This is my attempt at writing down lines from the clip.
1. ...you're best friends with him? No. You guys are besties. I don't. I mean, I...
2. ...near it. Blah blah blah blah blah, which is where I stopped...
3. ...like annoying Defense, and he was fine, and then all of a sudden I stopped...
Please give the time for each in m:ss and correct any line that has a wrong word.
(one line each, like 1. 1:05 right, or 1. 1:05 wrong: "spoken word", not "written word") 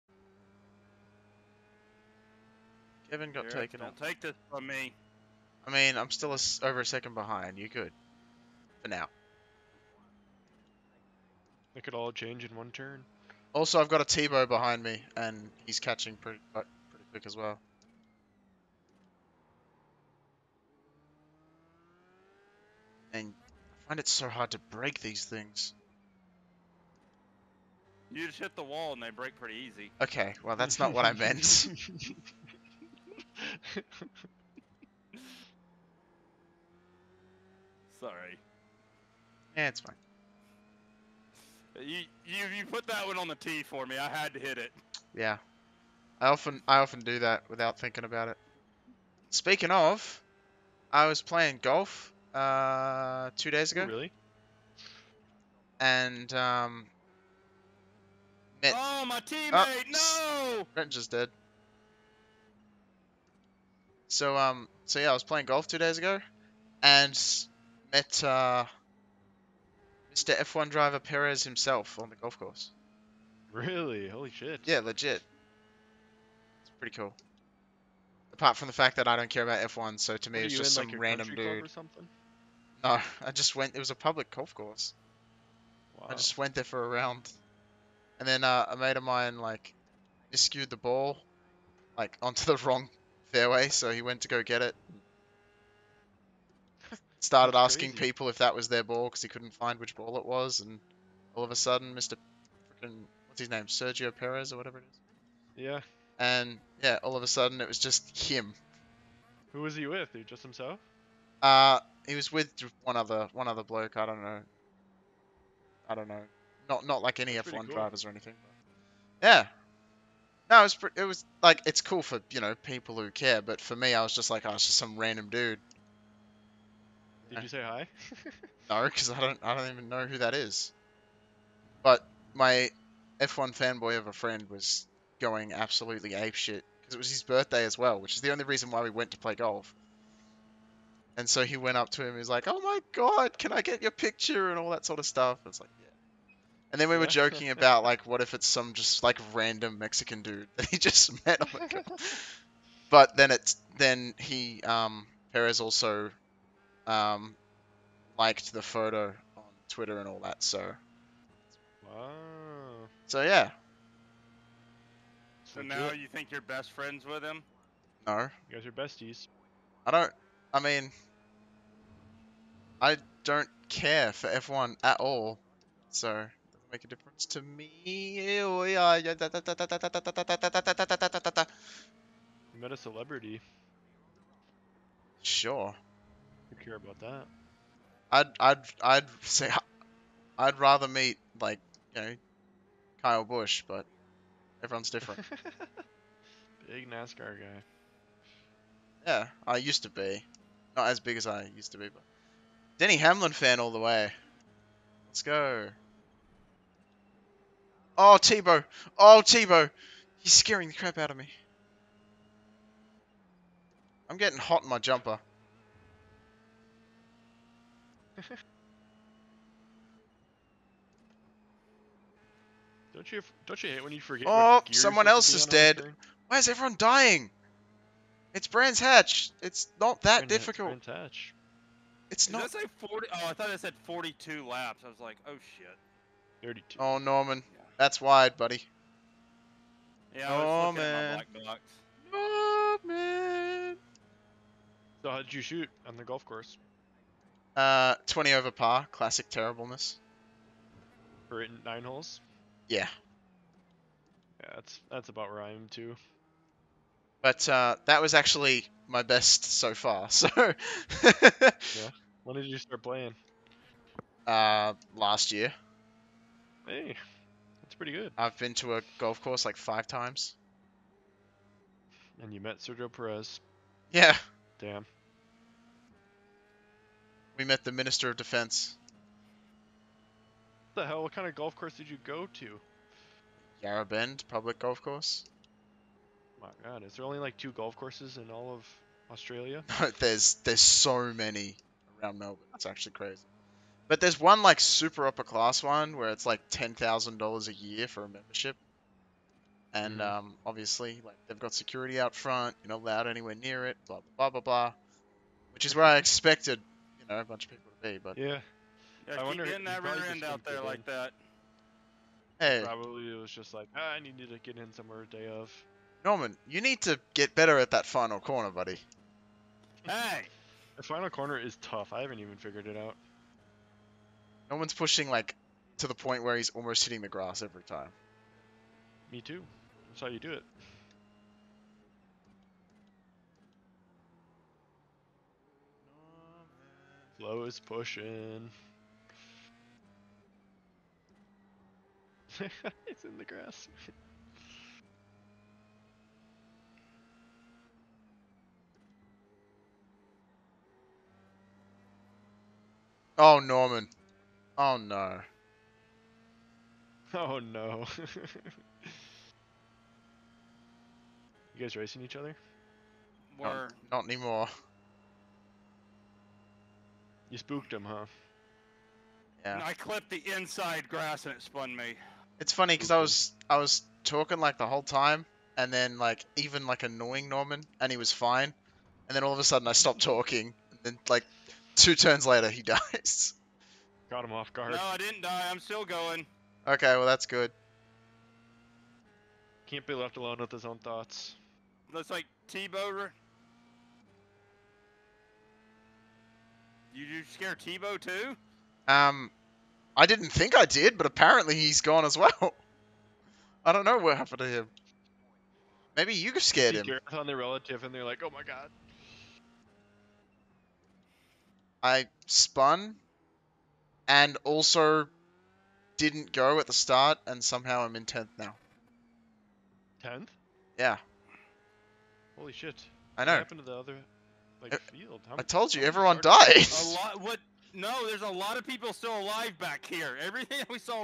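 1. 2:46 right
2. 5:03 wrong: "expected", not "stopped"
3. 6:16 wrong: "Norman", not "Defense".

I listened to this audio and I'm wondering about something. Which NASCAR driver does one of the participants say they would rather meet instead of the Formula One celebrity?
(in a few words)
Kyle Busch.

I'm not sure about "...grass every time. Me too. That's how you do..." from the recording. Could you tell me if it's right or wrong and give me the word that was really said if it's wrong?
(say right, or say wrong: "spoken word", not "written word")
right.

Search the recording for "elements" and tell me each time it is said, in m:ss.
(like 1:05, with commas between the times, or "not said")
not said.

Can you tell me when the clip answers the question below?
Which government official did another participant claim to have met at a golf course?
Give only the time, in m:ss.
4:37.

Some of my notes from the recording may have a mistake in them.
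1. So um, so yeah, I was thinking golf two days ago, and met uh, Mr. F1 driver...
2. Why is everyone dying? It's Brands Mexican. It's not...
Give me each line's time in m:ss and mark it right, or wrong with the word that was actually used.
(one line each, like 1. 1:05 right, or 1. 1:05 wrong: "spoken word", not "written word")
1. 1:04 wrong: "playing", not "thinking"
2. 3:46 wrong: "Hatch", not "Mexican".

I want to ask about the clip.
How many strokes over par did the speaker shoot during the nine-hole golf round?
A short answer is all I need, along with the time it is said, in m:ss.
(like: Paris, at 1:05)
20, at 4:08.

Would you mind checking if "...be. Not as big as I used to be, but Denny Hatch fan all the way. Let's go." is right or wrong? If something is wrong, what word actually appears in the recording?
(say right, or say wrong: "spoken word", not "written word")
wrong: "Hamlin", not "Hatch".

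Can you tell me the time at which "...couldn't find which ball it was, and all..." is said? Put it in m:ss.
1:39.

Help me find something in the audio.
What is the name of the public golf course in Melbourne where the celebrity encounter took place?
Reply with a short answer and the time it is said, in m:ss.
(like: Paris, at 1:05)
Yarra Bend Public Golf Course, at 4:43.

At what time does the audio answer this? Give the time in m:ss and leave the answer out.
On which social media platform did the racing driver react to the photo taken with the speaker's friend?
2:39.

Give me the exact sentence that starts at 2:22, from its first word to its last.
He's like, "Oh my god, can I get your picture?" and all that sort of stuff.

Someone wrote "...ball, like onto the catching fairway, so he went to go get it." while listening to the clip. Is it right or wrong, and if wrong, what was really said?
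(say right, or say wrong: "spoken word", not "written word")
wrong: "wrong", not "catching".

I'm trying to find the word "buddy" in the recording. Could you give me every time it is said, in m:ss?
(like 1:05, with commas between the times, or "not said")
3:58, 5:18.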